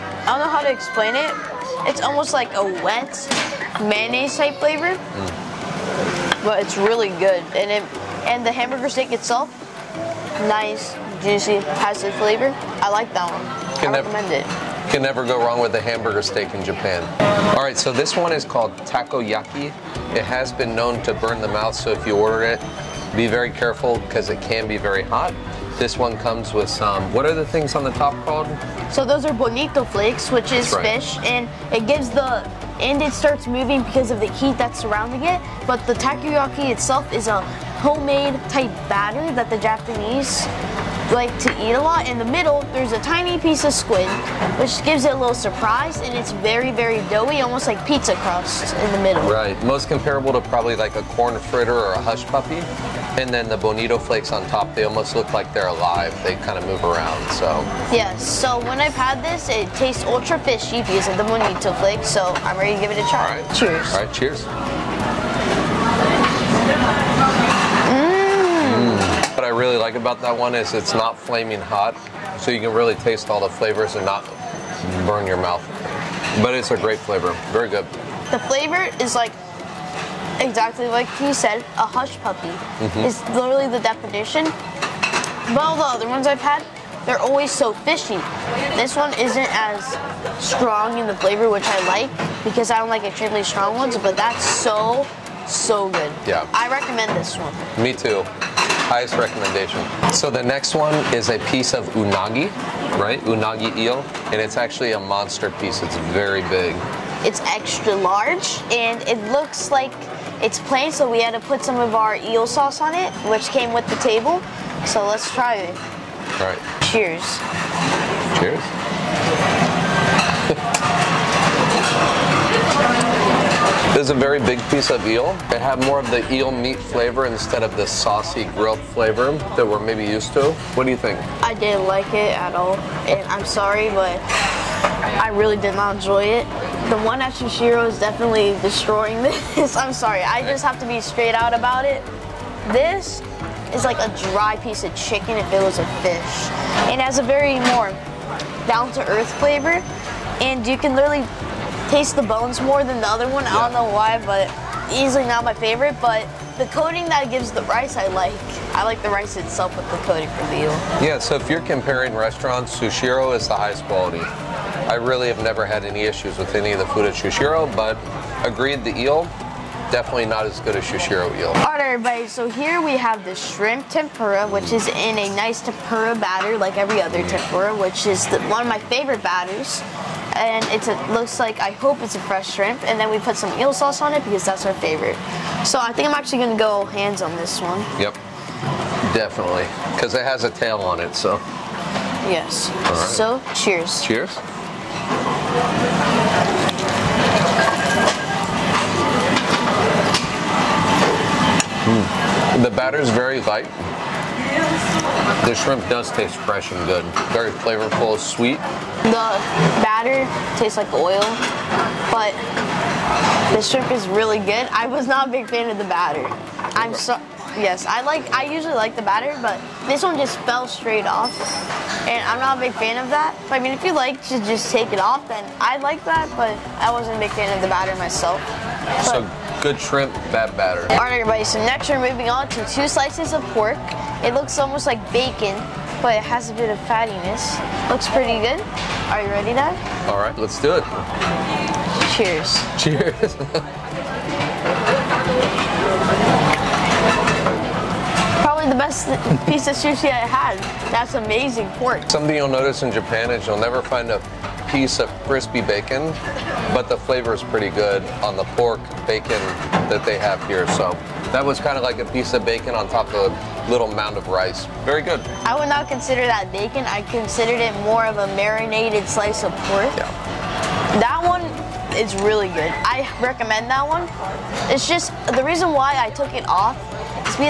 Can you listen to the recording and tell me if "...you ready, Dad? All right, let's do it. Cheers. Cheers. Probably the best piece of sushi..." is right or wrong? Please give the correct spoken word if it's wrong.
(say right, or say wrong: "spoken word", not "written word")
right.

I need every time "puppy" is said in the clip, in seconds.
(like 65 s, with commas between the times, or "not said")
52 s, 82 s.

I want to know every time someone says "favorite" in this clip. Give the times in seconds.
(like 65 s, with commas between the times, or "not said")
155 s, 178 s, 184 s.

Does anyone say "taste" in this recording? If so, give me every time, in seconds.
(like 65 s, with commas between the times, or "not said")
59 s, 72 s, 151 s, 206 s, 210 s.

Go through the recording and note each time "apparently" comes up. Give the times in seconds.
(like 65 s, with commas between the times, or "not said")
not said.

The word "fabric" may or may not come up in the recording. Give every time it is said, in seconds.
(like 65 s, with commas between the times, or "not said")
not said.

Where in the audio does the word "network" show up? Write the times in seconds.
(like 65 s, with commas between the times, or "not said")
not said.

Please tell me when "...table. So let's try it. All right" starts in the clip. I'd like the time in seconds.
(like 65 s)
113 s.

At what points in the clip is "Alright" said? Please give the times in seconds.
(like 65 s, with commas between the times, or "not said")
171 s, 230 s.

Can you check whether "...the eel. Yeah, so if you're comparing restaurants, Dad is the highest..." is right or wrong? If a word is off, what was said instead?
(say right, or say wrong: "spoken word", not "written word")
wrong: "Sushiro", not "Dad".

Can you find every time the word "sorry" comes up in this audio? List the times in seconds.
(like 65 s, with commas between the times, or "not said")
133 s, 139 s.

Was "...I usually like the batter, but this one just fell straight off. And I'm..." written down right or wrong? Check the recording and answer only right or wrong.
right.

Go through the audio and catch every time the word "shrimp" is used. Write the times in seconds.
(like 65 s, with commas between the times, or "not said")
173 s, 182 s, 205 s, 213 s, 229 s.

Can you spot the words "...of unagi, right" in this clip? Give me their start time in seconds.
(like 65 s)
101 s.